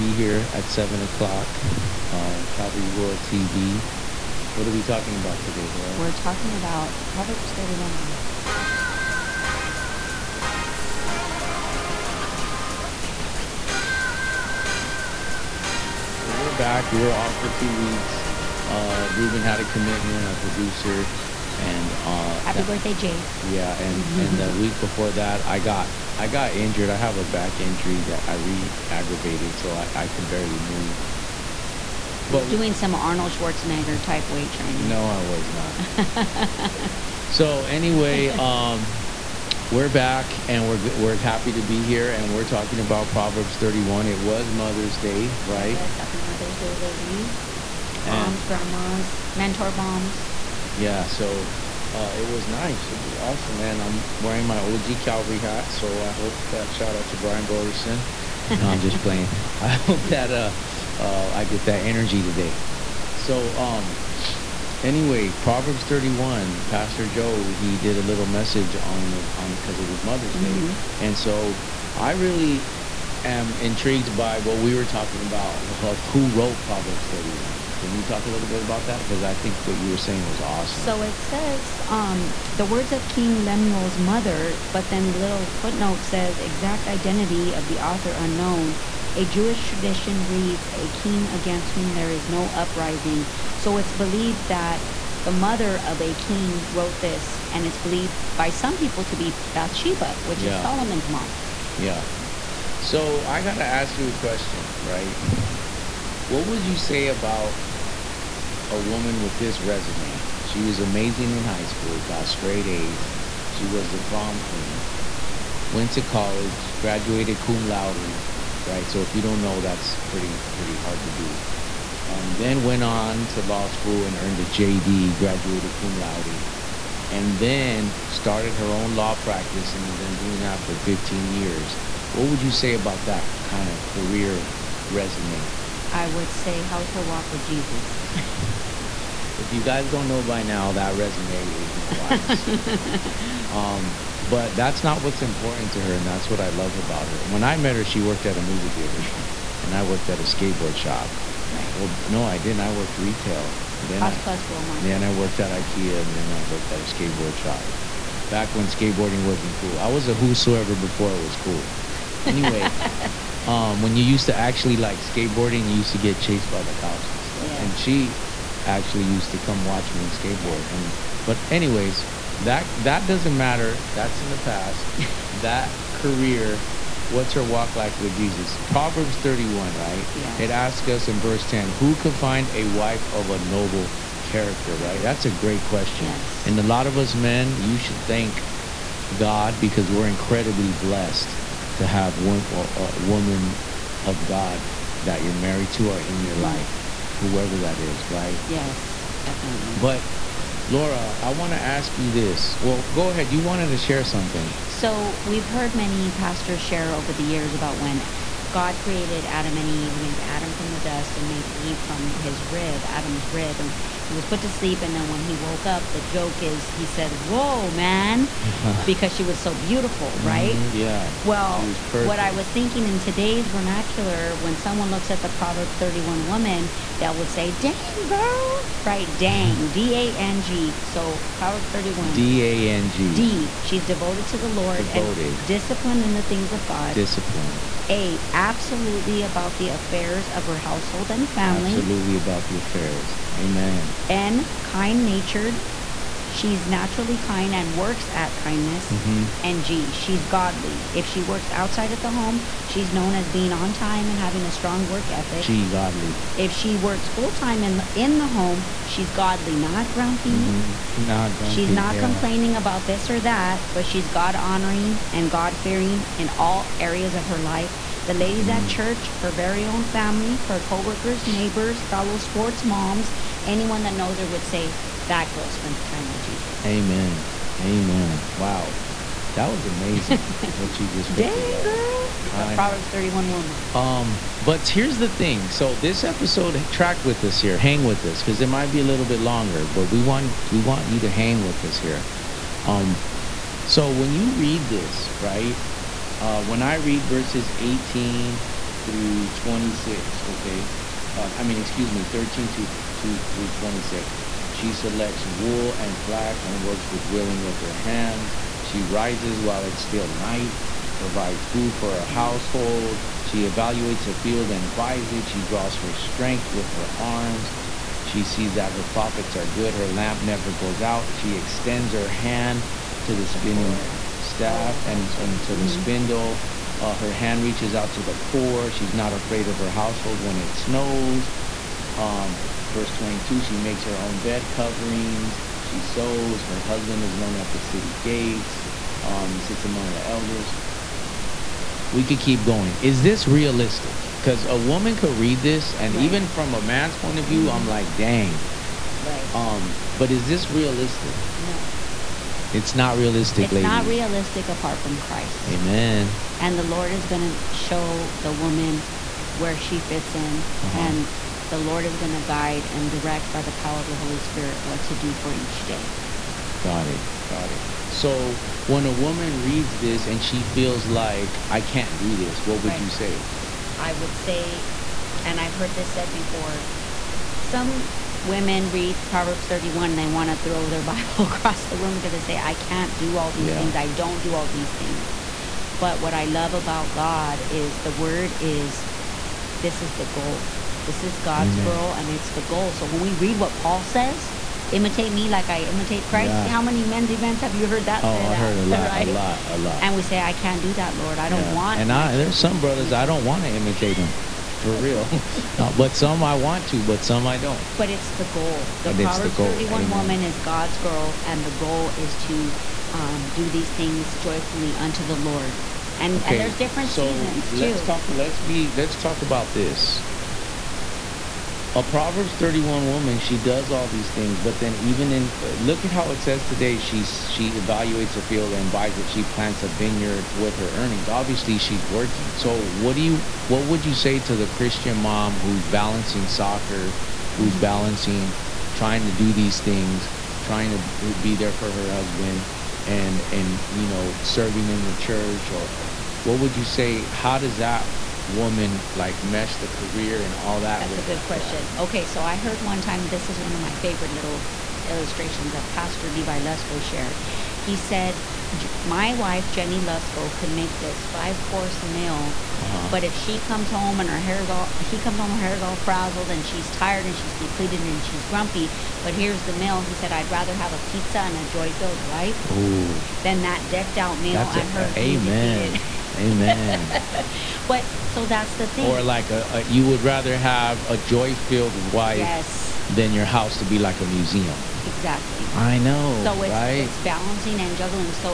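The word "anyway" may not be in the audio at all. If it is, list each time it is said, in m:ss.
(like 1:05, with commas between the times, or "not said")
0:37, 1:04, 2:42, 2:51.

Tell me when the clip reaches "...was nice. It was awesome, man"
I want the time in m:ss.
0:52.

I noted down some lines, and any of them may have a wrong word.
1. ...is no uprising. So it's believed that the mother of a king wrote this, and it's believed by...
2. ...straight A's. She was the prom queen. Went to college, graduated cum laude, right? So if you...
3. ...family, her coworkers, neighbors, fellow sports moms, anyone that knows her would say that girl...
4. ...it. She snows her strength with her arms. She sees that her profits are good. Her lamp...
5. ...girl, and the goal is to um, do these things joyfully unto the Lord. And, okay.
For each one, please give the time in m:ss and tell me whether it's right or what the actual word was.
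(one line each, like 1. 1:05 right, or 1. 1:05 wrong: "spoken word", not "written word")
1. 1:32 right
2. 1:52 right
3. 4:29 right
4. 5:15 wrong: "draws", not "snows"
5. 6:50 right.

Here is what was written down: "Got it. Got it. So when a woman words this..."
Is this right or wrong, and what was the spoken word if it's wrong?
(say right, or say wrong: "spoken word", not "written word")
wrong: "reads", not "words".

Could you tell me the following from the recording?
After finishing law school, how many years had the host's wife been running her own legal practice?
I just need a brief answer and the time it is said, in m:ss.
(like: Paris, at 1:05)
15 years, at 2:10.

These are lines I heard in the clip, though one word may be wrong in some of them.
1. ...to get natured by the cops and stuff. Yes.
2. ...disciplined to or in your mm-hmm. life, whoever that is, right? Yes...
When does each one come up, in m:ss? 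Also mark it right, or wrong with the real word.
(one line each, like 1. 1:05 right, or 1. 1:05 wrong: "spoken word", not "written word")
1. 2:45 wrong: "chased", not "natured"
2. 3:15 wrong: "married", not "disciplined".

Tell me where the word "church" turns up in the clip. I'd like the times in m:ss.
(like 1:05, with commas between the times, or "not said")
4:28, 7:24.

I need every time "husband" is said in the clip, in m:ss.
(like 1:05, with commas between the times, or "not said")
5:36, 7:21.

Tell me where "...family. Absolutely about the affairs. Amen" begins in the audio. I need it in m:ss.
4:01.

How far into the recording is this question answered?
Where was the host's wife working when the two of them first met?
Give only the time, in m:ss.
2:28.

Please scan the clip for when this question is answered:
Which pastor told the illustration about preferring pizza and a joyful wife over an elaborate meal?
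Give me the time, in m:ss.
7:36.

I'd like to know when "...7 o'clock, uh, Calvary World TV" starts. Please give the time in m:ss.
0:00.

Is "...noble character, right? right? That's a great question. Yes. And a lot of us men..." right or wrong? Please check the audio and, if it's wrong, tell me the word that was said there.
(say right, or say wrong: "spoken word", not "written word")
right.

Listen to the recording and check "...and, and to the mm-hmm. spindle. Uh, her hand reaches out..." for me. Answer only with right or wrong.
right.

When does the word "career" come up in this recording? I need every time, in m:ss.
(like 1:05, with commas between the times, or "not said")
2:13, 2:55, 7:29.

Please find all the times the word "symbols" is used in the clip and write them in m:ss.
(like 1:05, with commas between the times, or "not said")
not said.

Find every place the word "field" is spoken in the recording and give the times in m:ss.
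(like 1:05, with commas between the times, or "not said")
5:14, 7:08.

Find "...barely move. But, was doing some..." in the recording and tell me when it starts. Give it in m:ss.
0:30.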